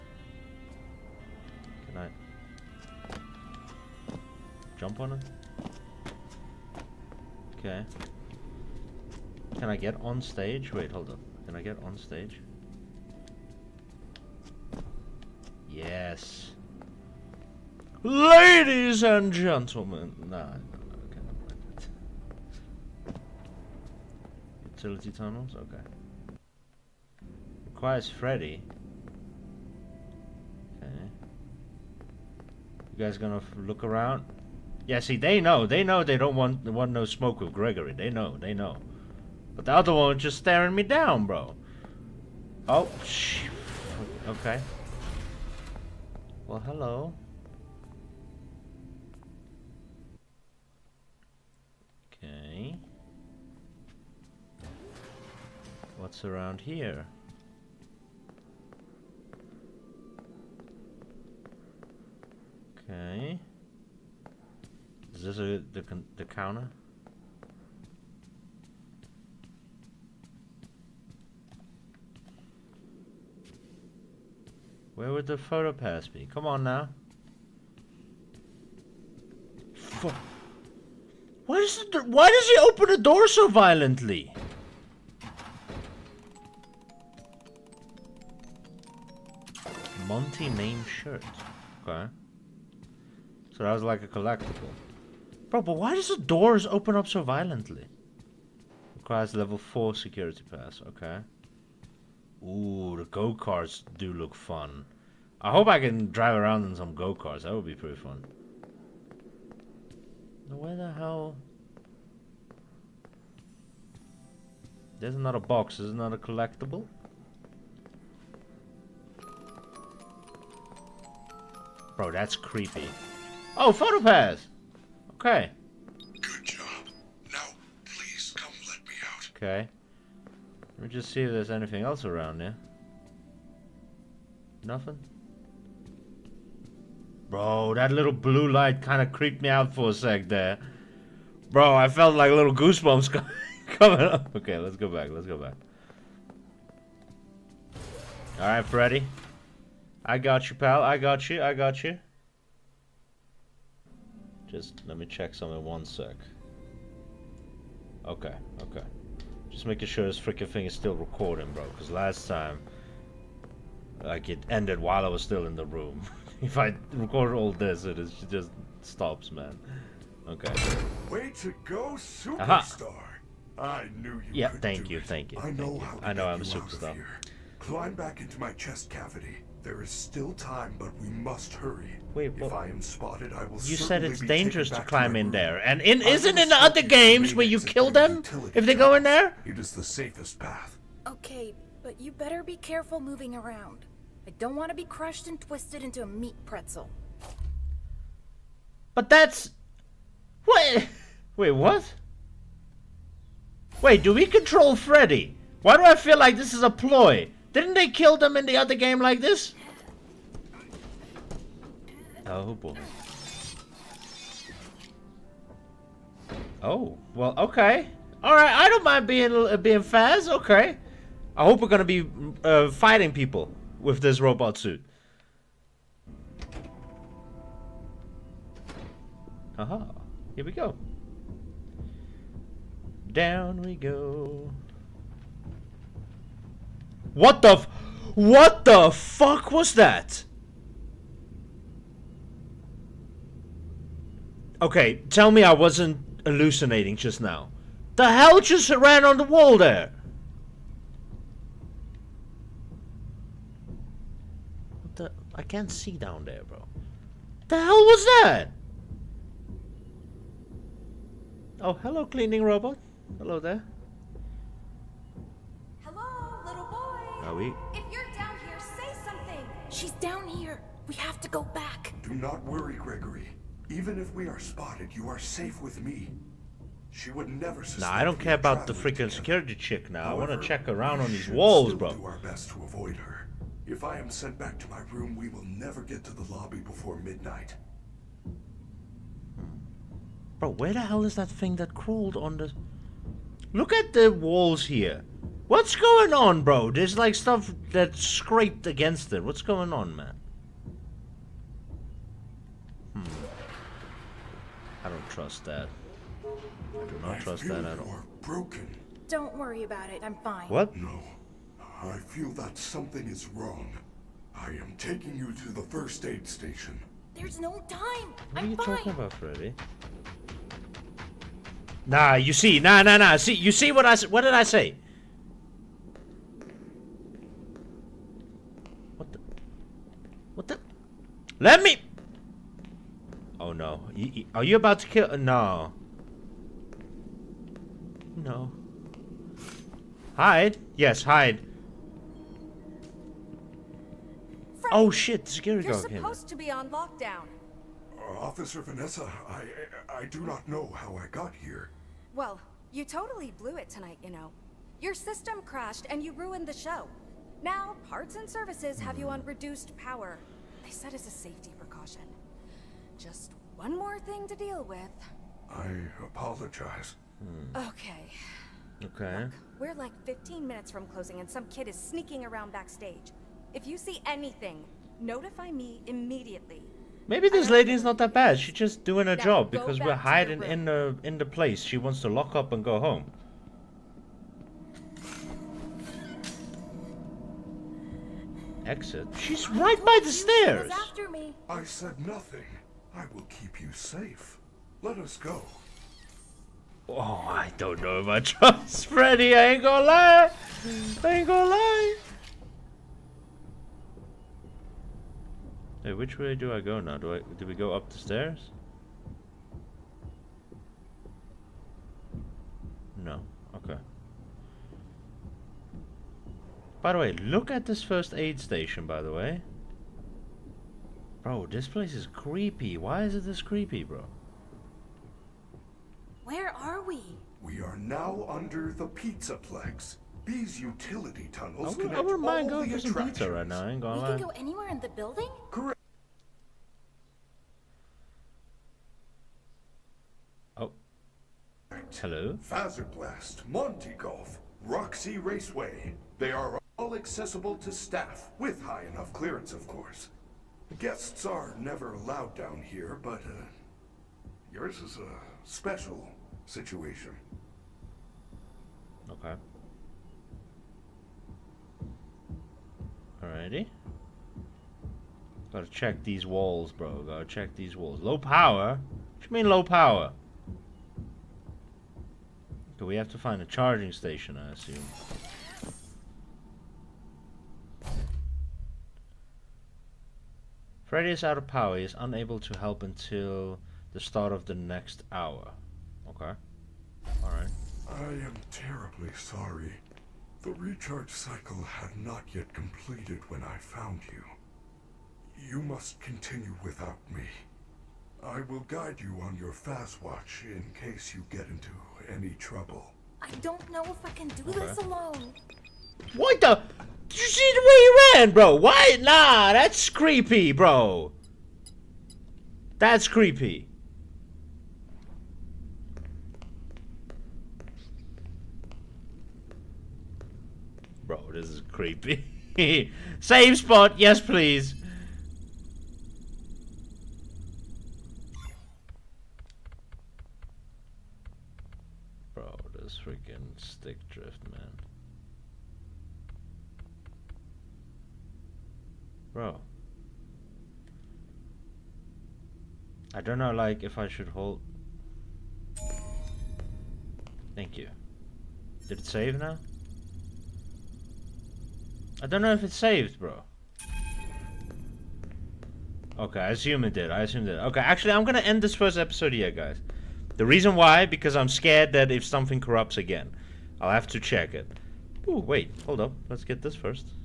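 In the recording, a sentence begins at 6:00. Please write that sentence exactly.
They said as a safety precaution.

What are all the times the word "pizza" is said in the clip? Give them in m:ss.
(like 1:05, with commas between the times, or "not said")
7:08, 7:13.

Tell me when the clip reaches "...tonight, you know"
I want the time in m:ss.
5:53.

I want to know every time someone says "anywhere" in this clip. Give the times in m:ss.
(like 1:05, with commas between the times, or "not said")
7:14.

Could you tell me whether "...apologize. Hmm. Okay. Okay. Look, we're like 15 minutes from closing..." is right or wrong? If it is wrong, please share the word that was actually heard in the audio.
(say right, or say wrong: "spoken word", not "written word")
right.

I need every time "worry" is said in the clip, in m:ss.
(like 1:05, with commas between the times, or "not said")
4:32, 5:09.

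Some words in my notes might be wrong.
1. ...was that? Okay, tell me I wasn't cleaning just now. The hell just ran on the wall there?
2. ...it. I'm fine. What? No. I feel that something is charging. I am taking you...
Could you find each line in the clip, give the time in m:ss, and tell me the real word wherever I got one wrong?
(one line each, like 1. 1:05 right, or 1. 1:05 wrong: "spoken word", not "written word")
1. 3:59 wrong: "hallucinating", not "cleaning"
2. 5:09 wrong: "wrong", not "charging".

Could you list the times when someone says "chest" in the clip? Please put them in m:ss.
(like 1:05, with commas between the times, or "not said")
2:58.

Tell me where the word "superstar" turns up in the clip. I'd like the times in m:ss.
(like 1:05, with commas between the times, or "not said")
2:51, 2:56.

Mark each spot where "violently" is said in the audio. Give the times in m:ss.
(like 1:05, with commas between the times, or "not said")
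1:23, 1:37.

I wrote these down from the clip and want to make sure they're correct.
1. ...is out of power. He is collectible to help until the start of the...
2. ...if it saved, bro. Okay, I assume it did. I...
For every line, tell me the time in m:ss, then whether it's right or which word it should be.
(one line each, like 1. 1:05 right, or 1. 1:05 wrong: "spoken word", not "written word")
1. 8:01 wrong: "unable", not "collectible"
2. 9:12 right.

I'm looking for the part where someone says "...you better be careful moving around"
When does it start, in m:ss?
3:11.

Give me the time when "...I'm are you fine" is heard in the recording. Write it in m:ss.
5:18.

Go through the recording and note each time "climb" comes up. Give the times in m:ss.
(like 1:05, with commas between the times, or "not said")
2:57, 3:04.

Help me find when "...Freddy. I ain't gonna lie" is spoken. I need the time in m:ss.
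6:38.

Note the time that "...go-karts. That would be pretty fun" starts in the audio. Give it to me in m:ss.
1:46.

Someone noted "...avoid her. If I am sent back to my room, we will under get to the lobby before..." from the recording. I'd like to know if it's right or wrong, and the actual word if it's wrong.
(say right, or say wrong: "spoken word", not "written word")
wrong: "never", not "under".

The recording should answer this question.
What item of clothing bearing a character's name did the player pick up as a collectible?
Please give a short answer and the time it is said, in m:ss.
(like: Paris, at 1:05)
Monty name shirt, at 1:30.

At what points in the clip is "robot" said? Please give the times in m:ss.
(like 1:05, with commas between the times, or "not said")
3:44, 4:22.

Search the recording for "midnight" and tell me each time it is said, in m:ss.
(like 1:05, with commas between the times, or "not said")
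4:46.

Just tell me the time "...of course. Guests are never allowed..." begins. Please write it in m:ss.
7:29.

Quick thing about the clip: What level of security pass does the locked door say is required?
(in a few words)
4.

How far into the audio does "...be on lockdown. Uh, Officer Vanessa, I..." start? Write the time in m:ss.
5:46.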